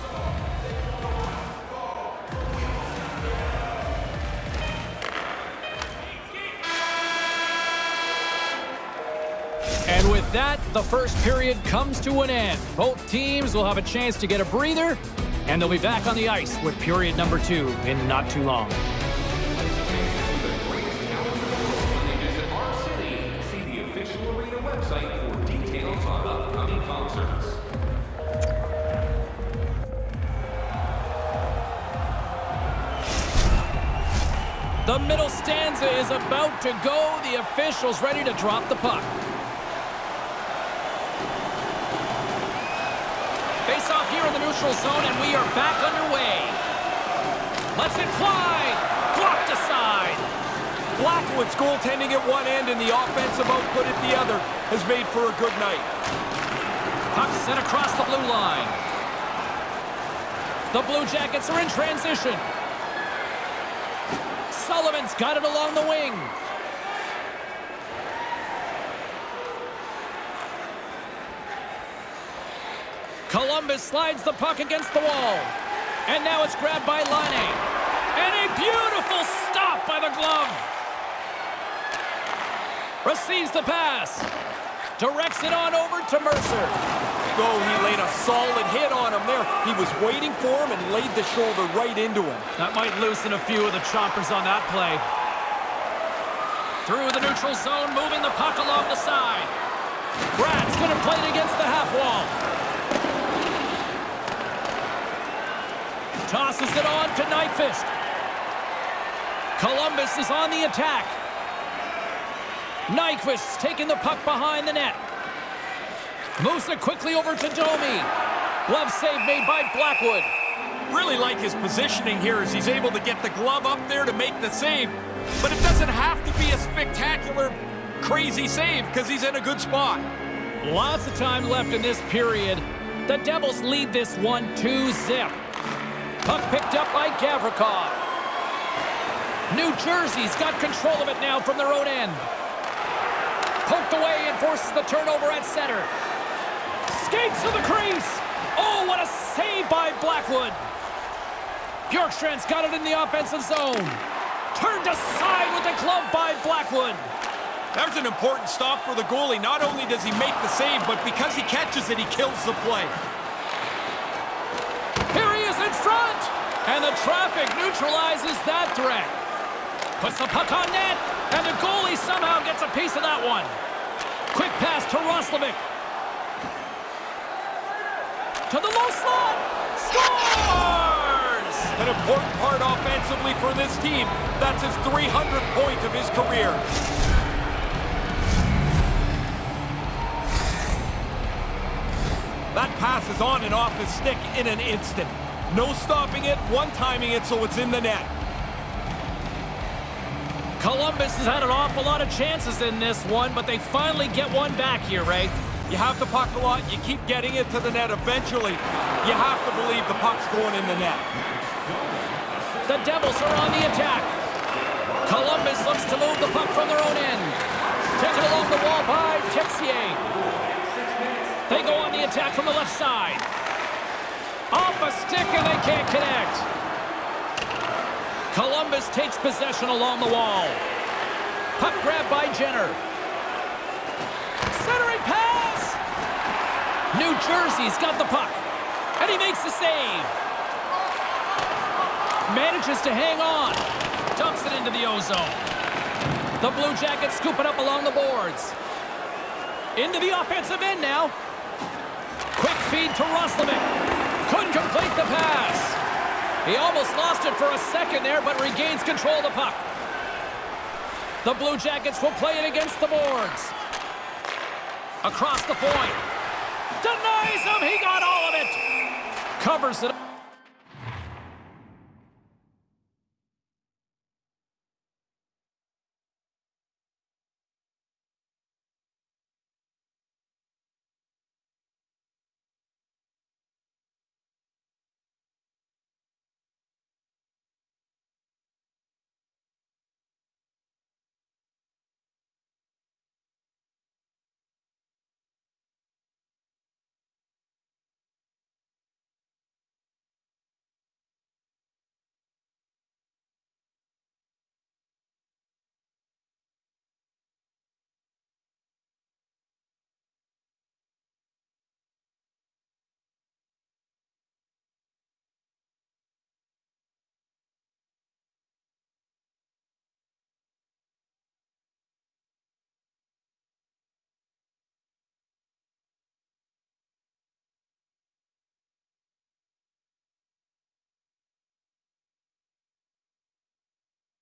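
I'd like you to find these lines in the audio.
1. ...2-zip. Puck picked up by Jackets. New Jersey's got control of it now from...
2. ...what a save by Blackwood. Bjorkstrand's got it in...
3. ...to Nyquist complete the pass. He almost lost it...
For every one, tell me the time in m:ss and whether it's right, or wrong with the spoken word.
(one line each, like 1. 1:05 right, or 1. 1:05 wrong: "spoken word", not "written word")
1. 2:14 wrong: "Gavrikov", not "Jackets"
2. 2:28 right
3. 4:12 wrong: "Roslovic", not "Nyquist".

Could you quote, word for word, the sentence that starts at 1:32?
That might loosen a few of the choppers on that play.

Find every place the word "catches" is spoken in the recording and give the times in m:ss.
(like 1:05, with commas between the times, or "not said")
2:41.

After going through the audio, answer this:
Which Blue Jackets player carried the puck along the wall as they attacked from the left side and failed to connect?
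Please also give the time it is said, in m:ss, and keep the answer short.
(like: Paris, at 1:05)
Texier, at 3:39.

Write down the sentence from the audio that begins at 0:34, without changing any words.
The middle stanza is about to go.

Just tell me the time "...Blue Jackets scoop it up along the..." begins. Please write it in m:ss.
4:06.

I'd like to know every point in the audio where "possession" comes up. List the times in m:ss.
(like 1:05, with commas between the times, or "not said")
3:49.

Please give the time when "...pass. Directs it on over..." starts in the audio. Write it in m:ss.
1:23.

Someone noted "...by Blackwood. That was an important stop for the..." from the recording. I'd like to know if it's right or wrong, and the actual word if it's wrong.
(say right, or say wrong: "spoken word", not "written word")
right.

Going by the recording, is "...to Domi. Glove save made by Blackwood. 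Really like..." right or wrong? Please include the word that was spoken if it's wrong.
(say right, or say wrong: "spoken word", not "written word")
right.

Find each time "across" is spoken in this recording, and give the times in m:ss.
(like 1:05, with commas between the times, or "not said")
0:57, 4:25.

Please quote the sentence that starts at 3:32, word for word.
The Devils are on the attack.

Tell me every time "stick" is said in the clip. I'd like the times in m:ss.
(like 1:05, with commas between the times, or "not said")
3:13, 3:45.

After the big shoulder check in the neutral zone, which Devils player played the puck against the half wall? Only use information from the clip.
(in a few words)
Bratt.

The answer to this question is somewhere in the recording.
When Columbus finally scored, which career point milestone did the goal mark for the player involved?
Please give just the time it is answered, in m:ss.
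3:04.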